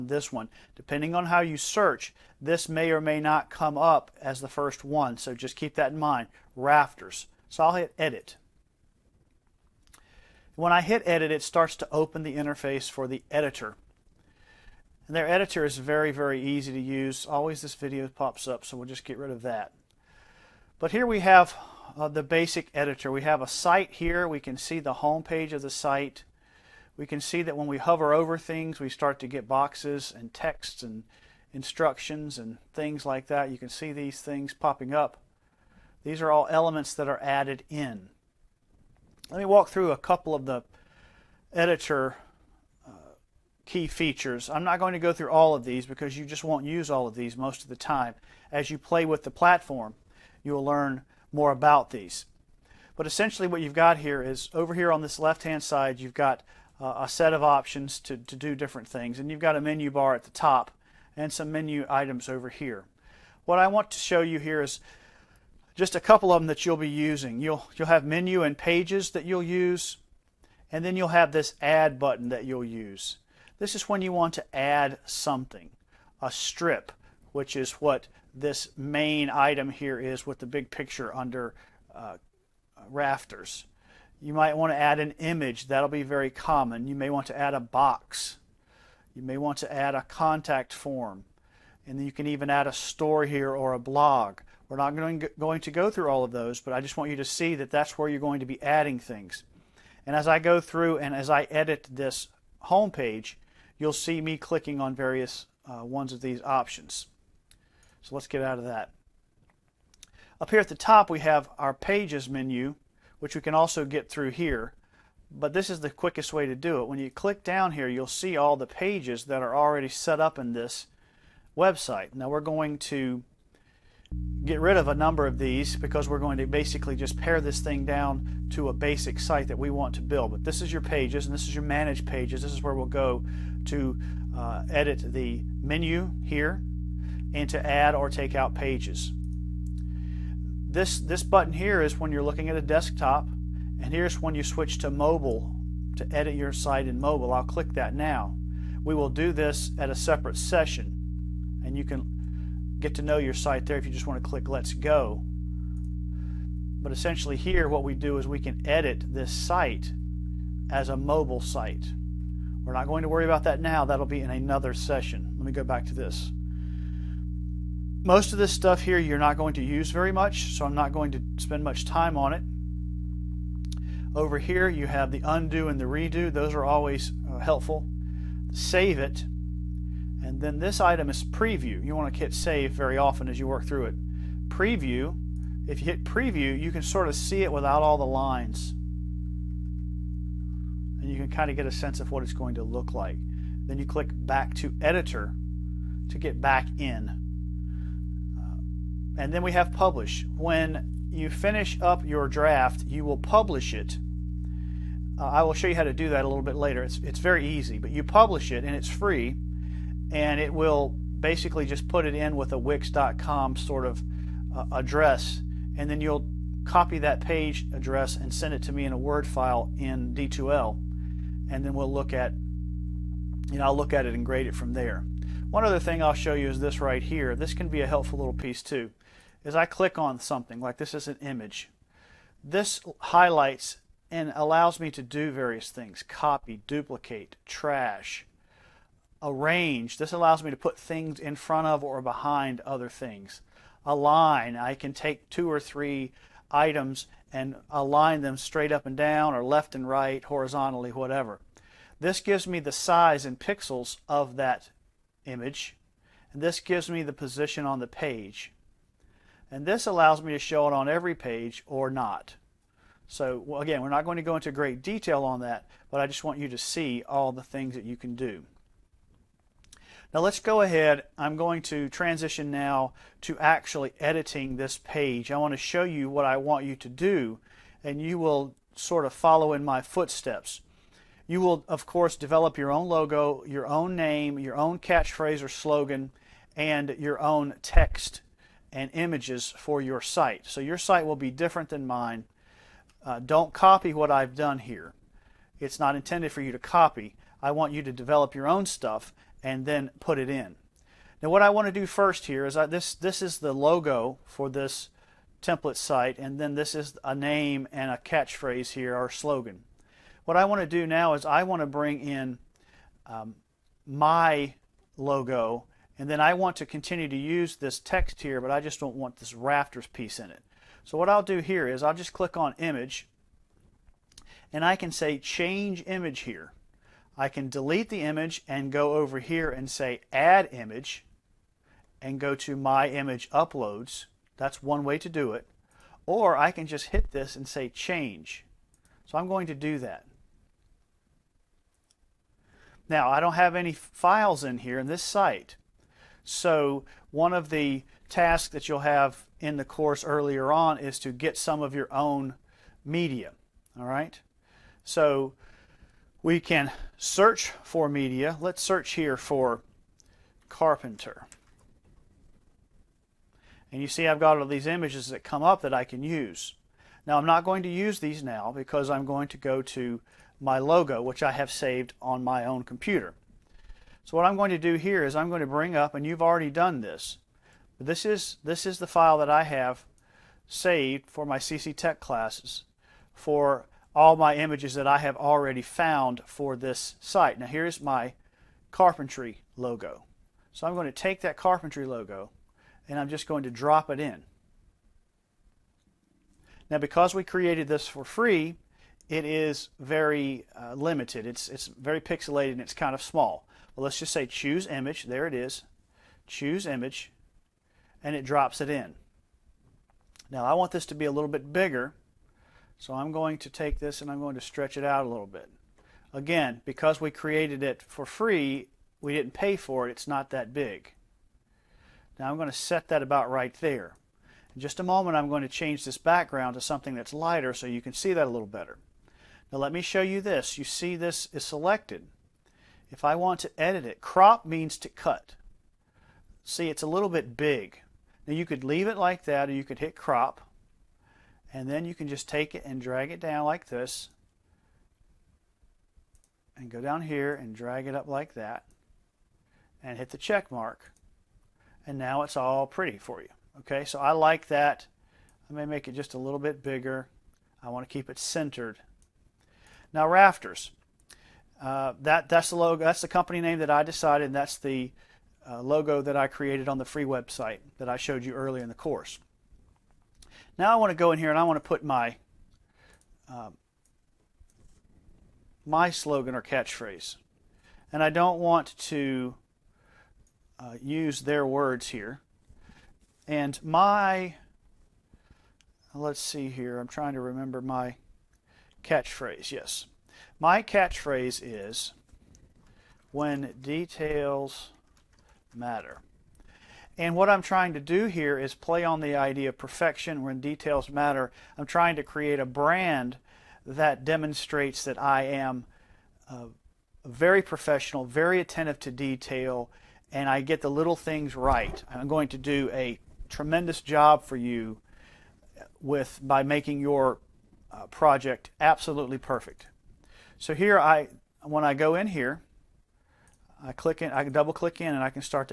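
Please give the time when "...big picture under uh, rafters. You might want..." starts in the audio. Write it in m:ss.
1:20.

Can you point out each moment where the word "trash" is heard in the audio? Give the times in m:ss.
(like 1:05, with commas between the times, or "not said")
3:57.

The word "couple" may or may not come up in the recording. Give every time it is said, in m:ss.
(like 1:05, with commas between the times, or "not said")
0:39, 1:05.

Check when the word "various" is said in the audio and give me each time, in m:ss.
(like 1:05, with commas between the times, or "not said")
1:44, 3:55.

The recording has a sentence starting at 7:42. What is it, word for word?
That's the company name that I decided.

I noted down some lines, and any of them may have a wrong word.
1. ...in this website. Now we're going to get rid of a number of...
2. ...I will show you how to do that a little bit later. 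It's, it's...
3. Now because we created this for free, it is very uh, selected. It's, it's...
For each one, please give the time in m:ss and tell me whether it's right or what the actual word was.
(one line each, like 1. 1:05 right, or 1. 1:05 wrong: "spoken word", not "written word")
1. 2:00 right
2. 3:25 right
3. 6:36 wrong: "limited", not "selected".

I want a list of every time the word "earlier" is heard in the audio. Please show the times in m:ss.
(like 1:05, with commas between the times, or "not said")
5:50, 7:48.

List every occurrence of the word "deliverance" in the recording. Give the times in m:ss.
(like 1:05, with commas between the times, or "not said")
not said.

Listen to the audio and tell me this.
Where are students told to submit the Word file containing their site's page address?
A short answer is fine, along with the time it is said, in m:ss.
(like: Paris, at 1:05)
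D2L, at 3:40.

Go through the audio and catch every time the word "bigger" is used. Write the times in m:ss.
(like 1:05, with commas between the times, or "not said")
6:51, 7:36.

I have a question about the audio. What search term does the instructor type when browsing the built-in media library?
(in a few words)
carpenter.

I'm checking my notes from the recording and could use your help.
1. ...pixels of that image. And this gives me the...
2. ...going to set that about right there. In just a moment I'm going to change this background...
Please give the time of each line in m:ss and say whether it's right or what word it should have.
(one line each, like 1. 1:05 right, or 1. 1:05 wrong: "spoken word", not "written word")
1. 4:13 right
2. 7:02 right.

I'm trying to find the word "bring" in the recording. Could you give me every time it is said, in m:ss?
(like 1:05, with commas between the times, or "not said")
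5:11, 6:15.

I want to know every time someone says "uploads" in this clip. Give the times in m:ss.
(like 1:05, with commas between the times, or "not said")
5:33.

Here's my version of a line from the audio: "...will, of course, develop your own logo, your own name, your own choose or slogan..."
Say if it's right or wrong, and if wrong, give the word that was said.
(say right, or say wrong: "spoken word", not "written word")
wrong: "catchphrase", not "choose".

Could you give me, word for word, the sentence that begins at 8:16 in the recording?
And what I'm trying to do here is play on the idea of perfection when details matter.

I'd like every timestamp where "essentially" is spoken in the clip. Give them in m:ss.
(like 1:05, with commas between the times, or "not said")
0:53, 2:36.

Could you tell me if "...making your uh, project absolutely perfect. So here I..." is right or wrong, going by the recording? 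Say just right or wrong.
right.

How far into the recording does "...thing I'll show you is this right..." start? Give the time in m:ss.
3:45.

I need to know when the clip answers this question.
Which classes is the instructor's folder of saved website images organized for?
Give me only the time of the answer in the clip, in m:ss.
6:21.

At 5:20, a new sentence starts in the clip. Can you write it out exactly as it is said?
So what I'll do here is I'll just click on image and I can say change image here.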